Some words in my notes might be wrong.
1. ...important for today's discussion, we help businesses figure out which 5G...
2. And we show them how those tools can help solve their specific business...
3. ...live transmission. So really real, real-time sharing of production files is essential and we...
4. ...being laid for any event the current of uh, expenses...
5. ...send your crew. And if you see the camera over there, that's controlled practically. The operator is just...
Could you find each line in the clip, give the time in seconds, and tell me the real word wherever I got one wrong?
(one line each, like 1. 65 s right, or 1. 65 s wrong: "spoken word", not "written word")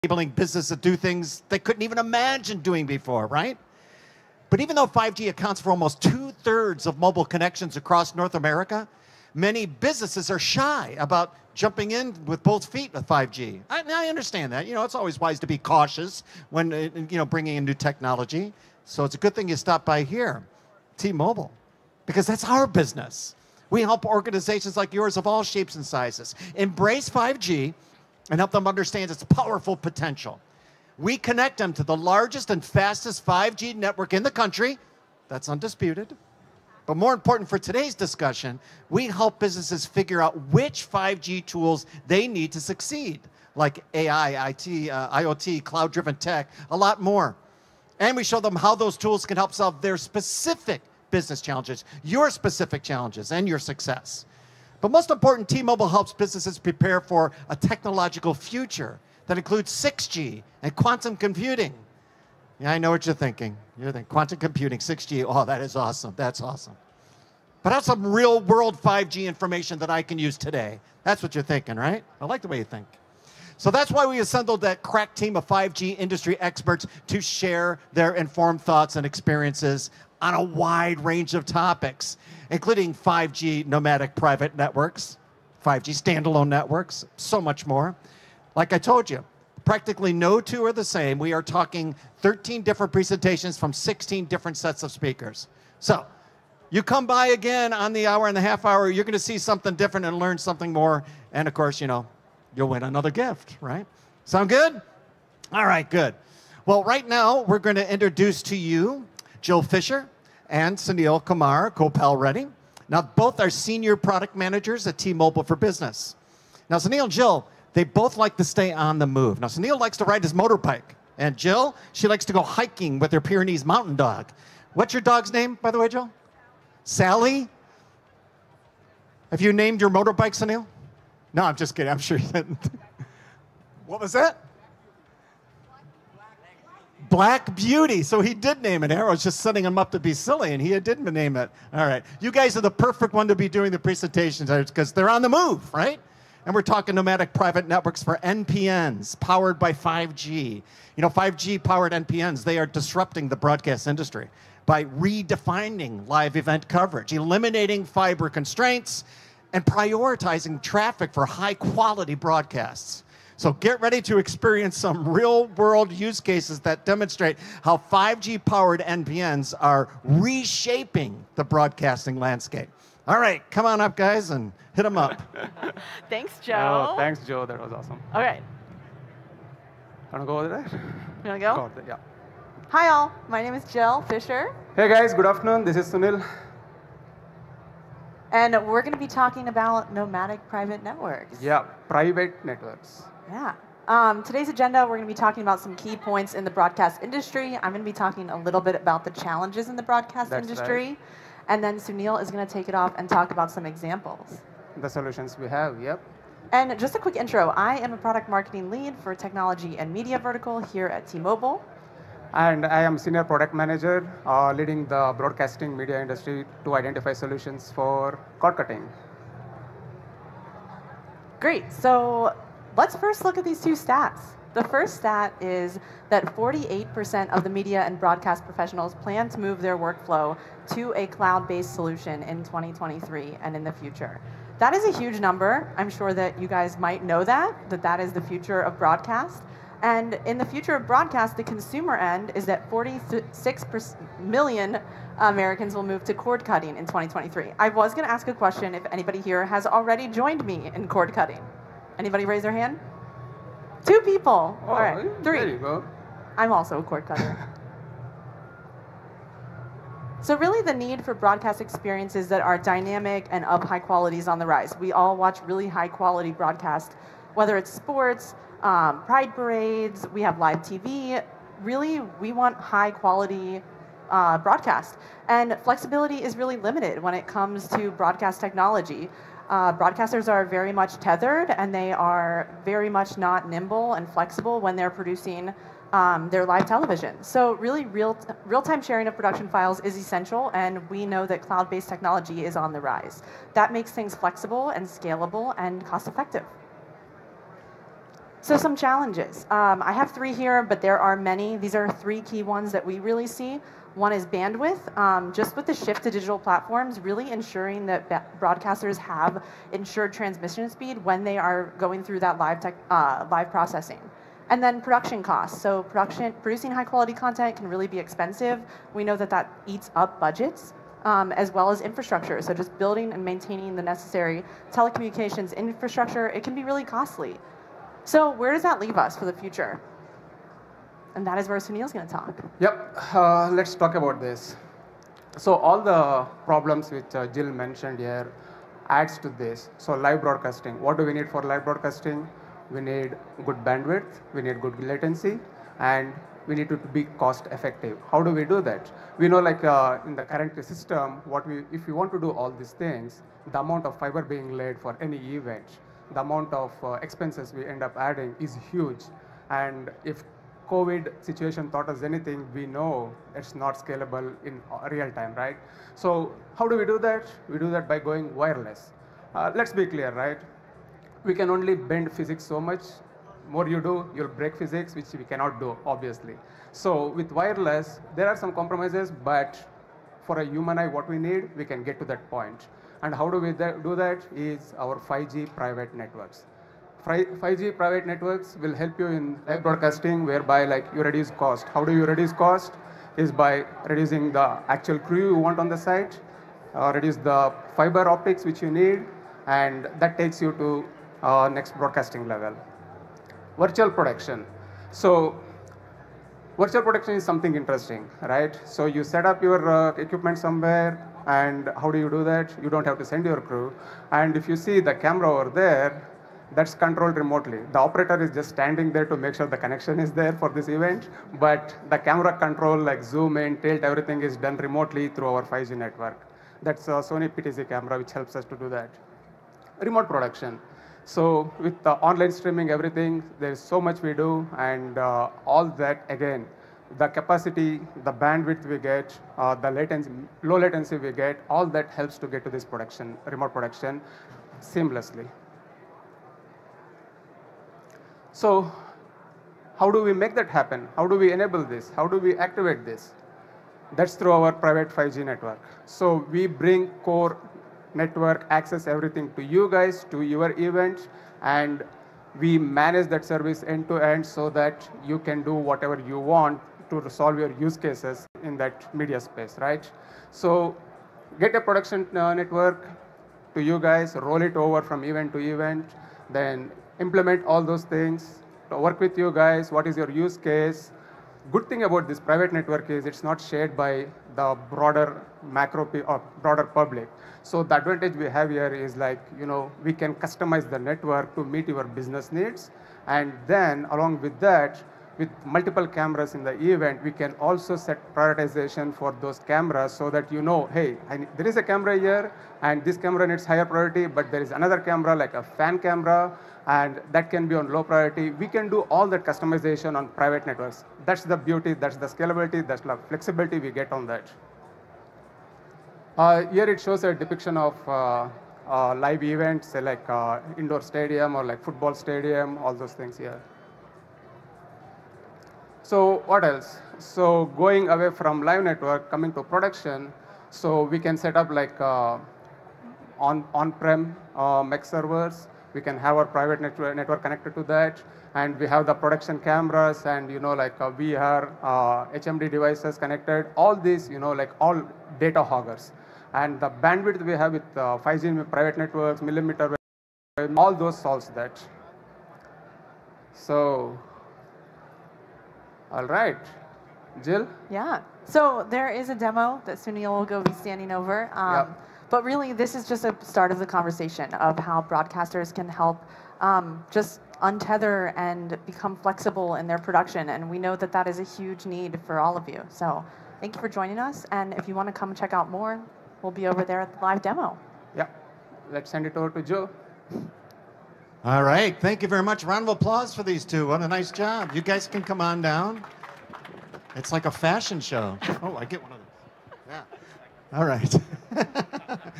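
1. 37 s right
2. 47 s right
3. 286 s wrong: "television", not "transmission"
4. 354 s wrong: "amount", not "current"
5. 413 s wrong: "remotely", not "practically".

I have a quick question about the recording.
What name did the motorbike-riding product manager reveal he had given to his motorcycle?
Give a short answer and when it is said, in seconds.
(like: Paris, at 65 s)
Black Beauty, at 137 s.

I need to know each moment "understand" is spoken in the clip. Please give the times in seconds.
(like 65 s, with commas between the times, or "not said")
14 s, 28 s.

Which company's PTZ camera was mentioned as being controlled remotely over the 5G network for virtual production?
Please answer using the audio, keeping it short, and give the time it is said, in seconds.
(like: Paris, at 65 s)
Sony, at 426 s.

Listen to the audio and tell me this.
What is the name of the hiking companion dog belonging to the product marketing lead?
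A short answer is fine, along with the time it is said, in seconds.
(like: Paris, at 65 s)
Sally, at 126 s.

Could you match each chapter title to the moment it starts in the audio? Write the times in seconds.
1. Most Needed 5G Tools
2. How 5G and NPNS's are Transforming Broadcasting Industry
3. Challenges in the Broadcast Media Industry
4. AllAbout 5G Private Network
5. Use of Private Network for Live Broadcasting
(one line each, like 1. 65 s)
1. 40 s
2. 163 s
3. 299 s
4. 390 s
5. 455 s.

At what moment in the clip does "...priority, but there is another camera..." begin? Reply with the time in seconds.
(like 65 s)
503 s.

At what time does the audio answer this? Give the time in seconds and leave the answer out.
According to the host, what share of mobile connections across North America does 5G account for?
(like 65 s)
5 s.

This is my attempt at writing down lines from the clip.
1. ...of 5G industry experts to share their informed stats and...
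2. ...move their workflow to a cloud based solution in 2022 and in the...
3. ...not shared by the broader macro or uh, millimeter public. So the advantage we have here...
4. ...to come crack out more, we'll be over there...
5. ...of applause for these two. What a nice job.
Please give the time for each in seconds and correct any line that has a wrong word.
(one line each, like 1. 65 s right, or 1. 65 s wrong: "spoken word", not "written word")
1. 75 s wrong: "thoughts", not "stats"
2. 229 s wrong: "2023", not "2022"
3. 483 s wrong: "broader", not "millimeter"
4. 574 s wrong: "check", not "crack"
5. 582 s right.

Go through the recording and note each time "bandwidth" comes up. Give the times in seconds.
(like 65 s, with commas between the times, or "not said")
304 s, 343 s, 438 s, 546 s.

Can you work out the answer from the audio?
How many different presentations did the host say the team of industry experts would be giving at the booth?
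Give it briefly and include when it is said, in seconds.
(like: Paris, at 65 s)
13, at 92 s.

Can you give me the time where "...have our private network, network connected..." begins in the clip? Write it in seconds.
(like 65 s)
536 s.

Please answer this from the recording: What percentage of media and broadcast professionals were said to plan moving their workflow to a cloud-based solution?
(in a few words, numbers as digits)
48%.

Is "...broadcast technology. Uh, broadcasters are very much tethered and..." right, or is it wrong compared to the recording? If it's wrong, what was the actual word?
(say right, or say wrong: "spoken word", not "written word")
right.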